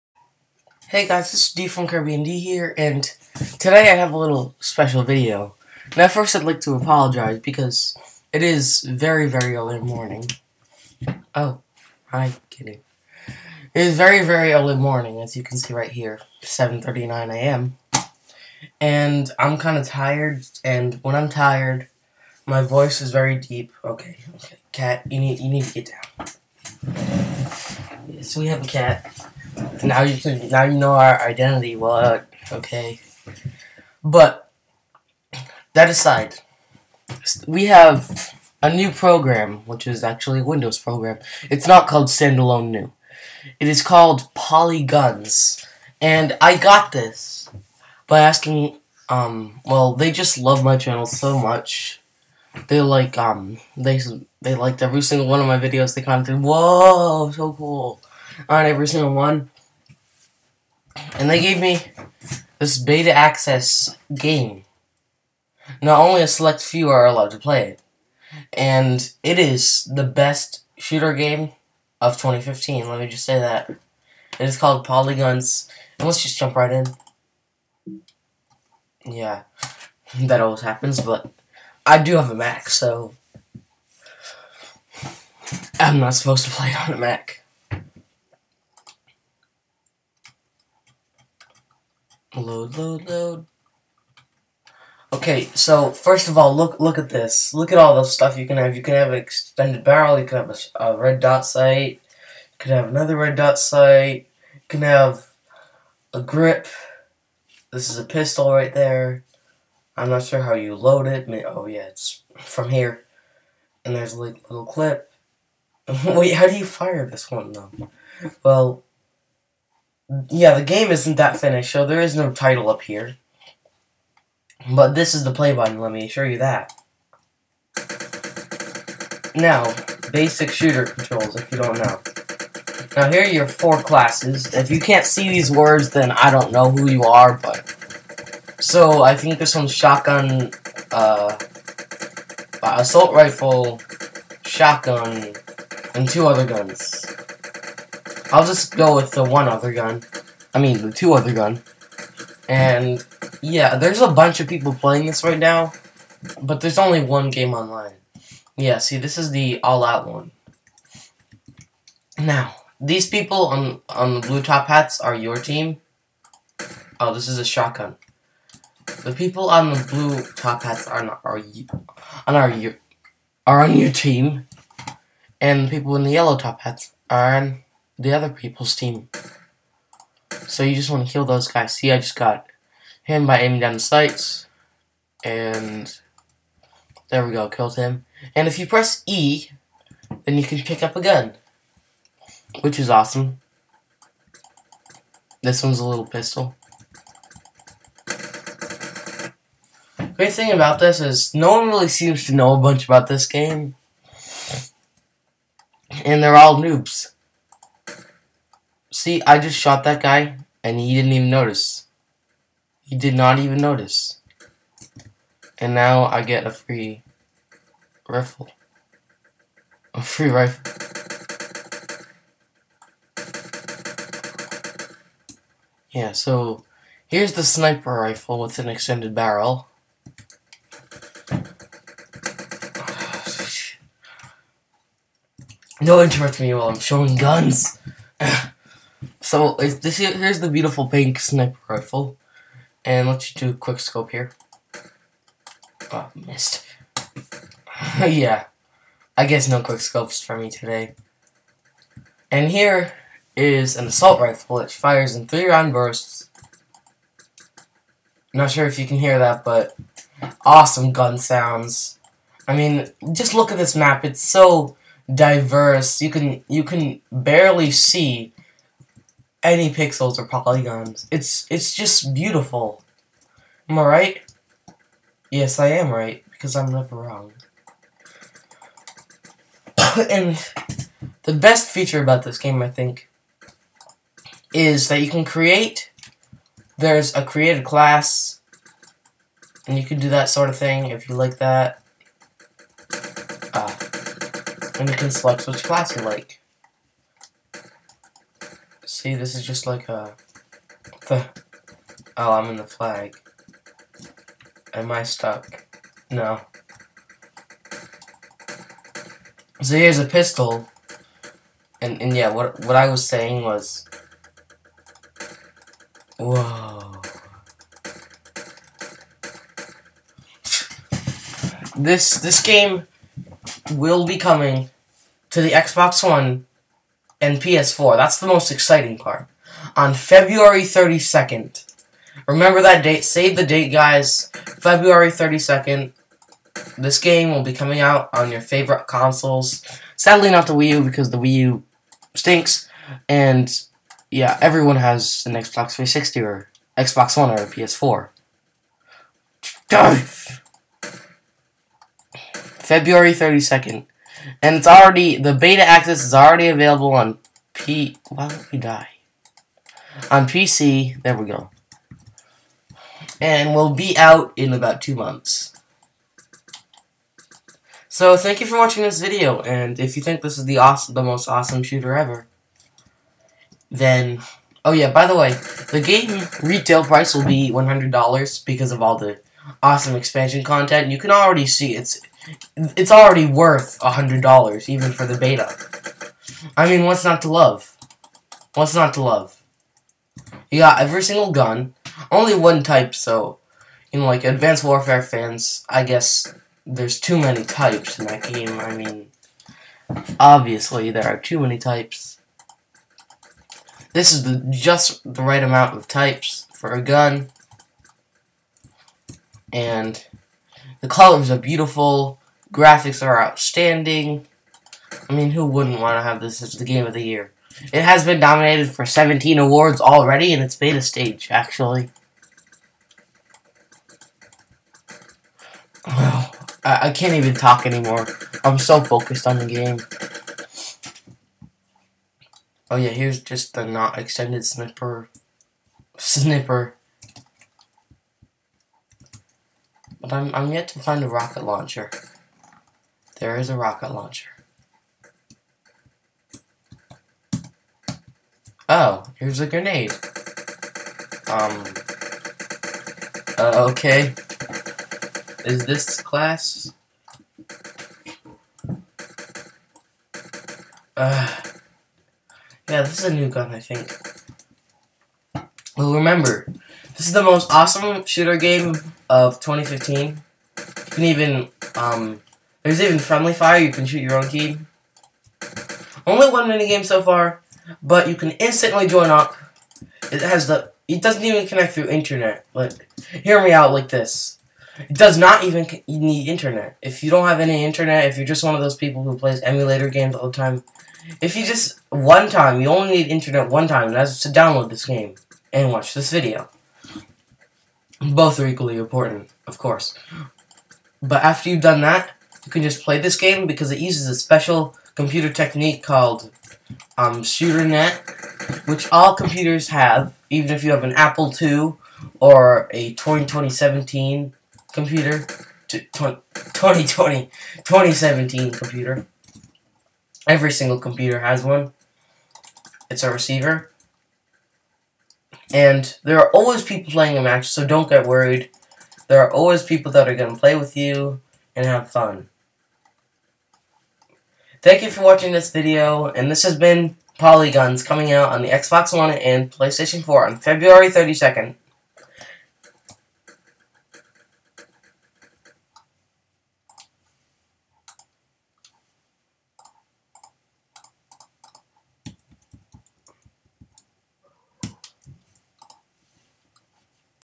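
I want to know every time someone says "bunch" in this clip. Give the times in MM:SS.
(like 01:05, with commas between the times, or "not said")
02:34, 03:22.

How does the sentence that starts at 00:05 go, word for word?
Now first I'd like to apologize because it is very, very early morning.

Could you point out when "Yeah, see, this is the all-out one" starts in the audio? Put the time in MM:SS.
02:38.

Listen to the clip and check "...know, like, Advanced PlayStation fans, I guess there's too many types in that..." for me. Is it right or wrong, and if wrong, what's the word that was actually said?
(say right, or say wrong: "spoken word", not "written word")
wrong: "Warfare", not "PlayStation".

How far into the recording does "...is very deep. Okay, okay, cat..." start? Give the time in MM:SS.
00:22.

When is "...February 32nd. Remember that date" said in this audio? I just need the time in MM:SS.
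05:29.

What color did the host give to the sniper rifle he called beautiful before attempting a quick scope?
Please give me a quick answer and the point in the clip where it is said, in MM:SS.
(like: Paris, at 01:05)
pink, at 04:00.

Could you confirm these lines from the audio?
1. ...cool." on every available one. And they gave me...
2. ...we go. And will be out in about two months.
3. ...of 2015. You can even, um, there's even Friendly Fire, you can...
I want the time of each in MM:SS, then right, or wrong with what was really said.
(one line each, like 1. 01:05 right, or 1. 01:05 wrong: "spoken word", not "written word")
1. 00:57 wrong: "single", not "available"
2. 06:01 right
3. 07:49 right.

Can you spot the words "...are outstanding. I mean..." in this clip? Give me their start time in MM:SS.
06:53.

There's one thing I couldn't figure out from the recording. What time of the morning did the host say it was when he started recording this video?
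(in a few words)
7:39 a.m.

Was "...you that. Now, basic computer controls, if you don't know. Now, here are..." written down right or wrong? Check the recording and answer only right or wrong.
wrong.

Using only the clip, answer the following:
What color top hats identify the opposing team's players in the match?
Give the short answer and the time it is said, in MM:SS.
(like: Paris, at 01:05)
yellow, at 02:56.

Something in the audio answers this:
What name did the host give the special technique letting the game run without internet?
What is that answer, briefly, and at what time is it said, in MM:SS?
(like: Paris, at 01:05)
ShooterNet, at 08:27.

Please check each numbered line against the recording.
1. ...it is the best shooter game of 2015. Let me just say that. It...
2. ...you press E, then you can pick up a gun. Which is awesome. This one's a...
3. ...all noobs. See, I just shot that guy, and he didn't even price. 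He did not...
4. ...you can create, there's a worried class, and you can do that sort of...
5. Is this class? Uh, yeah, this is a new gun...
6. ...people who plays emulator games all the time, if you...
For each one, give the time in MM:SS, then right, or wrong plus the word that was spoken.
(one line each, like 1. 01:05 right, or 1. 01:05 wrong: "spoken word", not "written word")
1. 01:09 right
2. 03:08 right
3. 03:26 wrong: "notice", not "price"
4. 04:45 wrong: "created", not "worried"
5. 07:35 right
6. 08:08 right.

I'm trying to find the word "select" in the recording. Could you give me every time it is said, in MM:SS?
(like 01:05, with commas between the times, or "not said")
01:06, 04:55.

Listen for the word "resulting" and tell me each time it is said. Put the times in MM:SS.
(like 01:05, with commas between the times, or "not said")
not said.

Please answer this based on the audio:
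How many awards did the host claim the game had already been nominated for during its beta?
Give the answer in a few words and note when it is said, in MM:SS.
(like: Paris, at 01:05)
17, at 06:58.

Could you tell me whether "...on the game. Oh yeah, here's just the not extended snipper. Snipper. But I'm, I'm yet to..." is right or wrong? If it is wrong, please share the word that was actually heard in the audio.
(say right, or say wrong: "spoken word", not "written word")
right.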